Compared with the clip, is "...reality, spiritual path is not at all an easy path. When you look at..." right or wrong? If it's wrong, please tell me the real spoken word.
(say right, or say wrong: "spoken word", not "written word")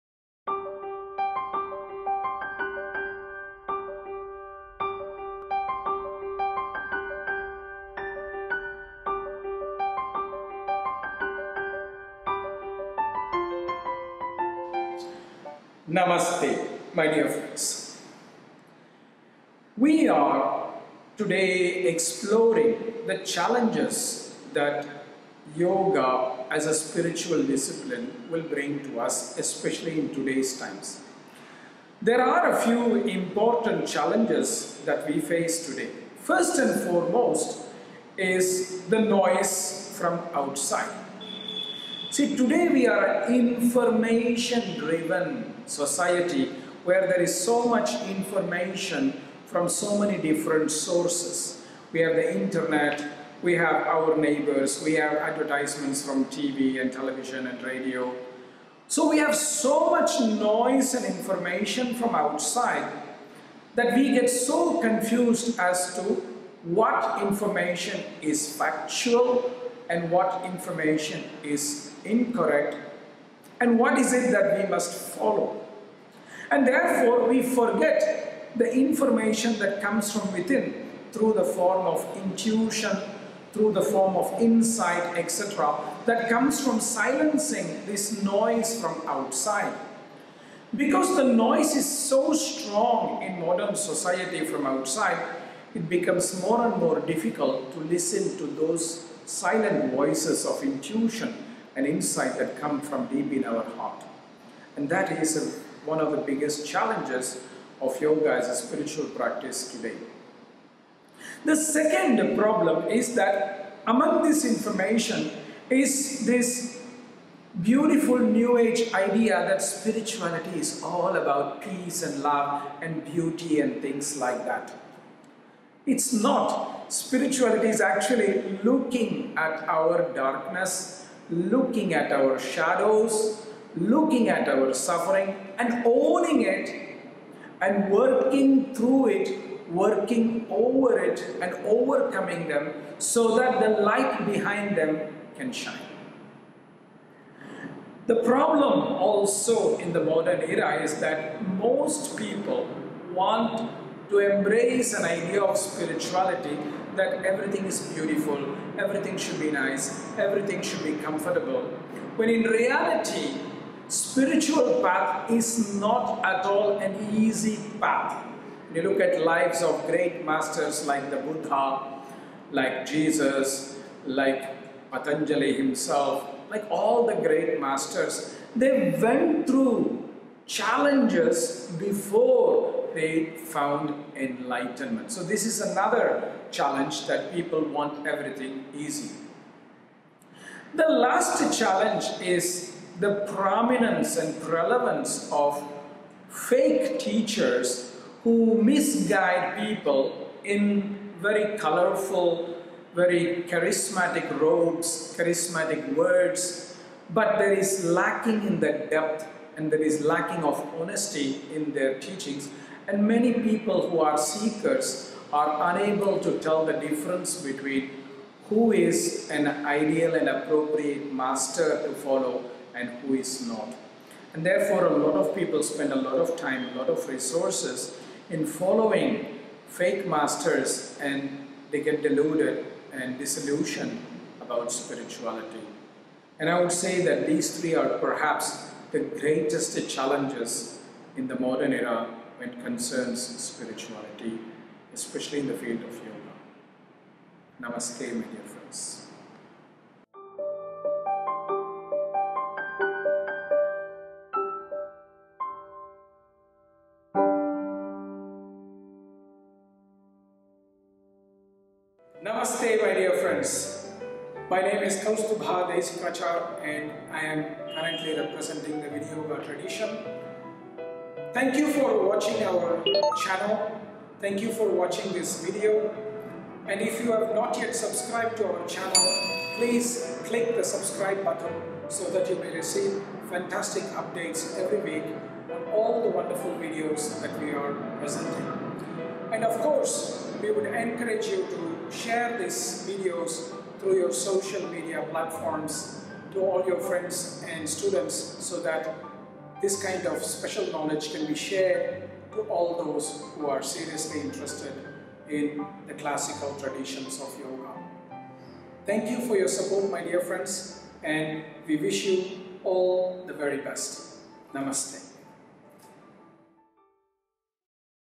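right.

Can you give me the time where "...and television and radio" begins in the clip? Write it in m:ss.
0:56.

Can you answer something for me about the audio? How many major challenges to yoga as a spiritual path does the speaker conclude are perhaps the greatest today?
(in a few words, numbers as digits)
3.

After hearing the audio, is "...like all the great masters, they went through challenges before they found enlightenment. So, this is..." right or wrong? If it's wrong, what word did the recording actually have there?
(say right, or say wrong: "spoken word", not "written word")
right.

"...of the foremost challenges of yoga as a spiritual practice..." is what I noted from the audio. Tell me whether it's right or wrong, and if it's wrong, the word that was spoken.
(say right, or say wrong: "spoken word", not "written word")
wrong: "biggest", not "foremost".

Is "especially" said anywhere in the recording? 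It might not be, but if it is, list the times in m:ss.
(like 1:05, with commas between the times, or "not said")
0:29, 4:04.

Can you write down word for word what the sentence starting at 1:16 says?
And therefore we forget the information that comes from within through the form of intuition, through the form of insight, etc.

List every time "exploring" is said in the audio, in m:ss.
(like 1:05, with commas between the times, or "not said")
0:21.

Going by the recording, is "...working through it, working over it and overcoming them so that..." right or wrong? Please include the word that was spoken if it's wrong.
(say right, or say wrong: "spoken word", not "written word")
right.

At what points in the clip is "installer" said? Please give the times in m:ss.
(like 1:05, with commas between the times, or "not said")
not said.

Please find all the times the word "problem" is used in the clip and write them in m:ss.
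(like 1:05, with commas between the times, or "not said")
1:52, 2:28.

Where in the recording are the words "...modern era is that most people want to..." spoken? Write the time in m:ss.
2:30.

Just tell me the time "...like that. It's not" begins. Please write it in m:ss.
2:04.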